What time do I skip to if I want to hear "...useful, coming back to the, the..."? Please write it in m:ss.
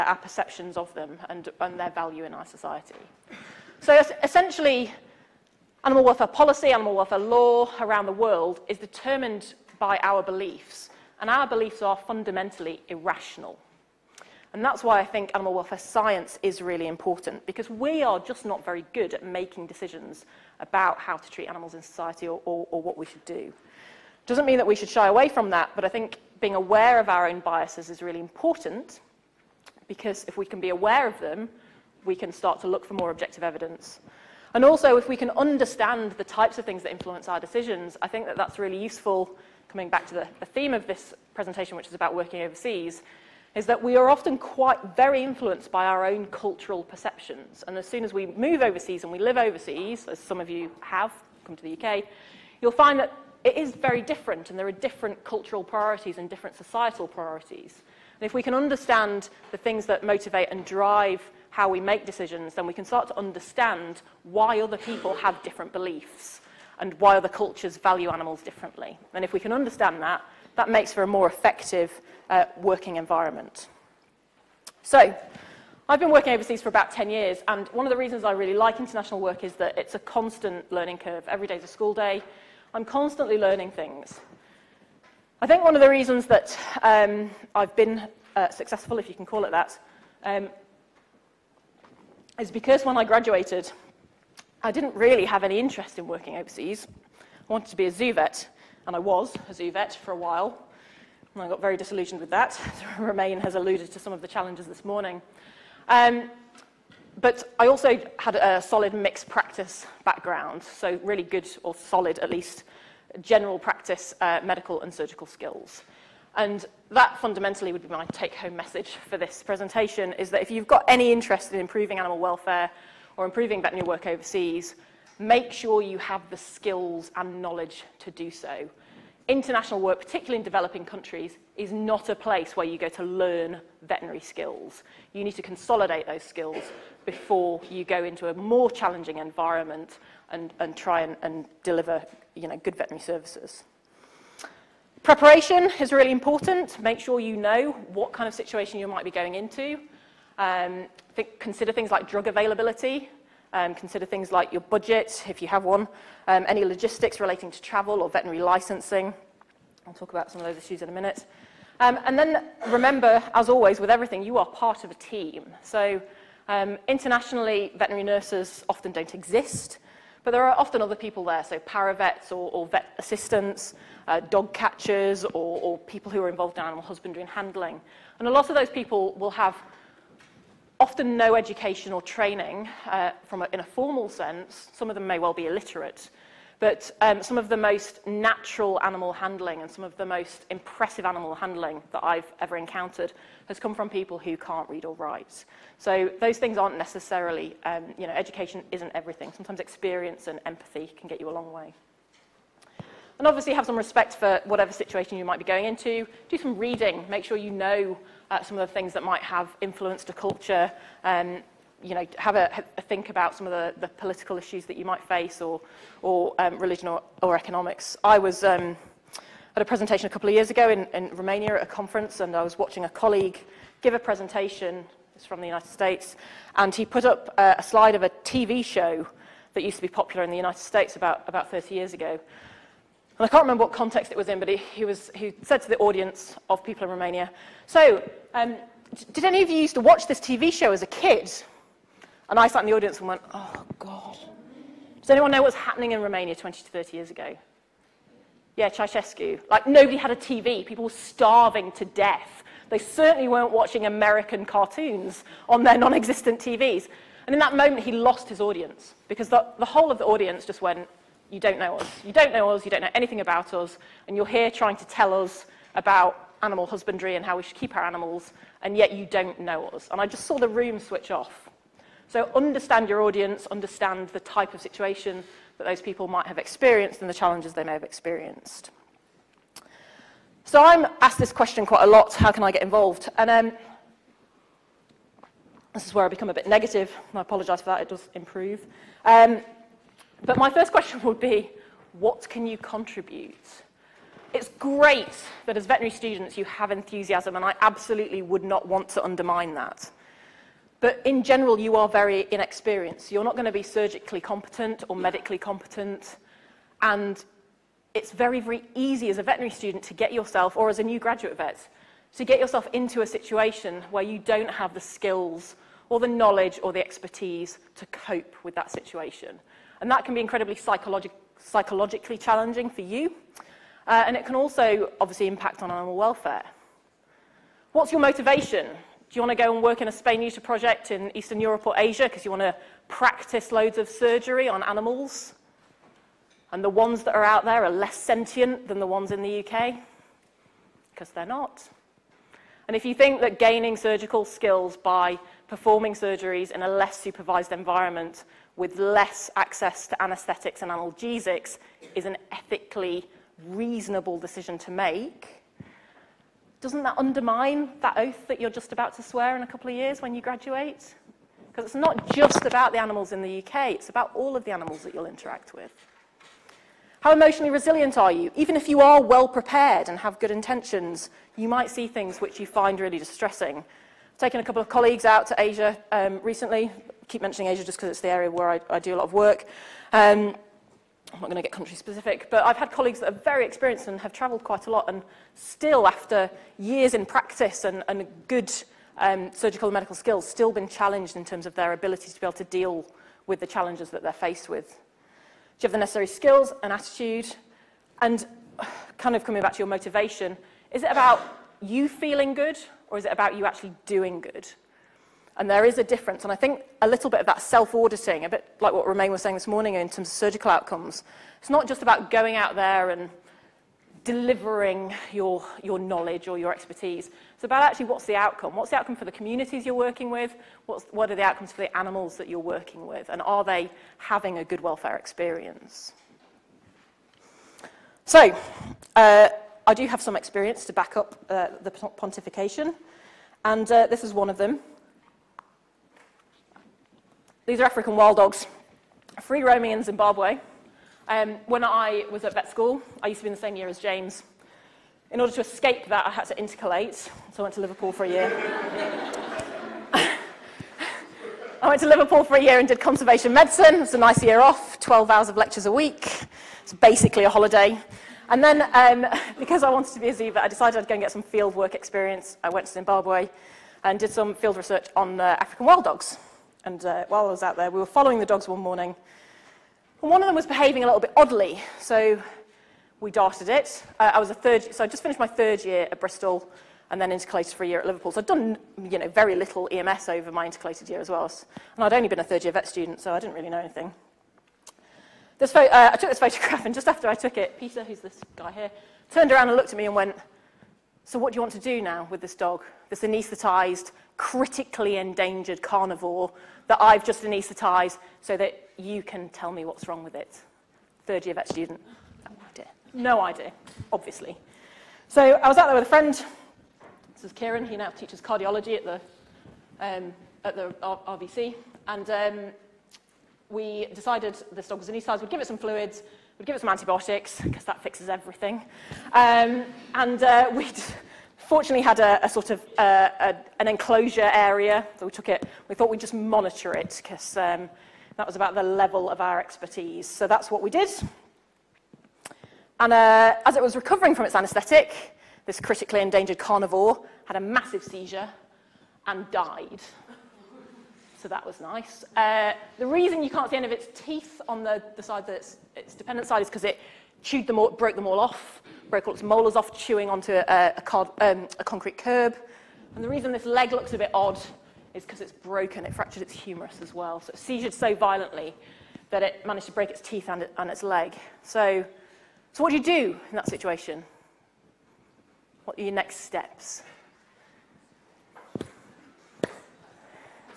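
0:38.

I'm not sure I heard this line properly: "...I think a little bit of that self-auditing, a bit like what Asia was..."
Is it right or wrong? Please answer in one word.
wrong.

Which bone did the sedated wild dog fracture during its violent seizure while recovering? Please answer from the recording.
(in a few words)
humerus.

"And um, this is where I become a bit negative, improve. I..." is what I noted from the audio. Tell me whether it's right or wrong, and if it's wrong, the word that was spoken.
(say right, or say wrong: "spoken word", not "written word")
wrong: "negative", not "improve".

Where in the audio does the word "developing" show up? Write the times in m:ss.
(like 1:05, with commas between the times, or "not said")
2:10.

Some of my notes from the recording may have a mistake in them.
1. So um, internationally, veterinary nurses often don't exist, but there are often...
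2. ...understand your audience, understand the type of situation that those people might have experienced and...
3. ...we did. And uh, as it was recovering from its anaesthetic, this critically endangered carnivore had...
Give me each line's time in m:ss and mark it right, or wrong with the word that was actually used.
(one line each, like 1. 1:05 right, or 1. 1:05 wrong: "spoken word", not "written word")
1. 2:45 right
2. 4:32 right
3. 8:50 right.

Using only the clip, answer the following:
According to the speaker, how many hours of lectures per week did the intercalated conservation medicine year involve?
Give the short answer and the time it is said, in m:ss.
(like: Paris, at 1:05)
12, at 7:34.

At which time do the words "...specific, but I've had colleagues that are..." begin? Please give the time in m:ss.
6:21.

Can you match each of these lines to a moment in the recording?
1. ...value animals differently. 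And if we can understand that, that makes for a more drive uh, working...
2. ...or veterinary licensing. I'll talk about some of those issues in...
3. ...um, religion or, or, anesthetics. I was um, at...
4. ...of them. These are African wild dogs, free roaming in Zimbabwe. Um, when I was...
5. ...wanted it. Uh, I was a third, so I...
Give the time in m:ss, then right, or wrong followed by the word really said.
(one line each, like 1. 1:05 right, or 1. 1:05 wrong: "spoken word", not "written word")
1. 1:07 wrong: "effective", not "drive"
2. 2:38 right
3. 3:36 wrong: "economics", not "anesthetics"
4. 7:14 right
5. 7:53 wrong: "darted", not "wanted".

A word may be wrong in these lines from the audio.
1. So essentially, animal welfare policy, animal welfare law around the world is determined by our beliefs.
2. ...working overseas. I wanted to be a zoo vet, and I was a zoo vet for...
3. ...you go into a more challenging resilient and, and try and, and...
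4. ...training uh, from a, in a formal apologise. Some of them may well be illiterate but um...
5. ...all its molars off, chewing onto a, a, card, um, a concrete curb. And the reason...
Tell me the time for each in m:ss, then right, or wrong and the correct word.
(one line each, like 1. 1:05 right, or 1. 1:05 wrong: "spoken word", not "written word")
1. 0:03 right
2. 1:36 right
3. 2:17 wrong: "environment", not "resilient"
4. 3:02 wrong: "sense", not "apologise"
5. 9:09 right.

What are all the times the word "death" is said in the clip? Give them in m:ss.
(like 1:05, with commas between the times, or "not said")
4:11.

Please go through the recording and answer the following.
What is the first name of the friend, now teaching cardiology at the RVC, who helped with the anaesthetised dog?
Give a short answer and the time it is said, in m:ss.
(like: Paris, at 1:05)
Kieran, at 8:27.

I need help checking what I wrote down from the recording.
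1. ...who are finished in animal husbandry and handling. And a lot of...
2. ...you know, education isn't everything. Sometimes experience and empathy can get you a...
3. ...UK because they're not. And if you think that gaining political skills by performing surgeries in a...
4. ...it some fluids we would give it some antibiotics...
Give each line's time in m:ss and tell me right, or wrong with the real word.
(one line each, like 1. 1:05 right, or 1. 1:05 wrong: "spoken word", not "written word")
1. 2:56 wrong: "involved", not "finished"
2. 3:17 right
3. 5:39 wrong: "surgical", not "political"
4. 8:35 right.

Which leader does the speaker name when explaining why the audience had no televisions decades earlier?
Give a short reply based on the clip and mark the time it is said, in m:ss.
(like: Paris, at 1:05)
Ceausescu, at 4:08.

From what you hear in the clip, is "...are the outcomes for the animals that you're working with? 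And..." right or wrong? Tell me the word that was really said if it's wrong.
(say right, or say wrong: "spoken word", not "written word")
right.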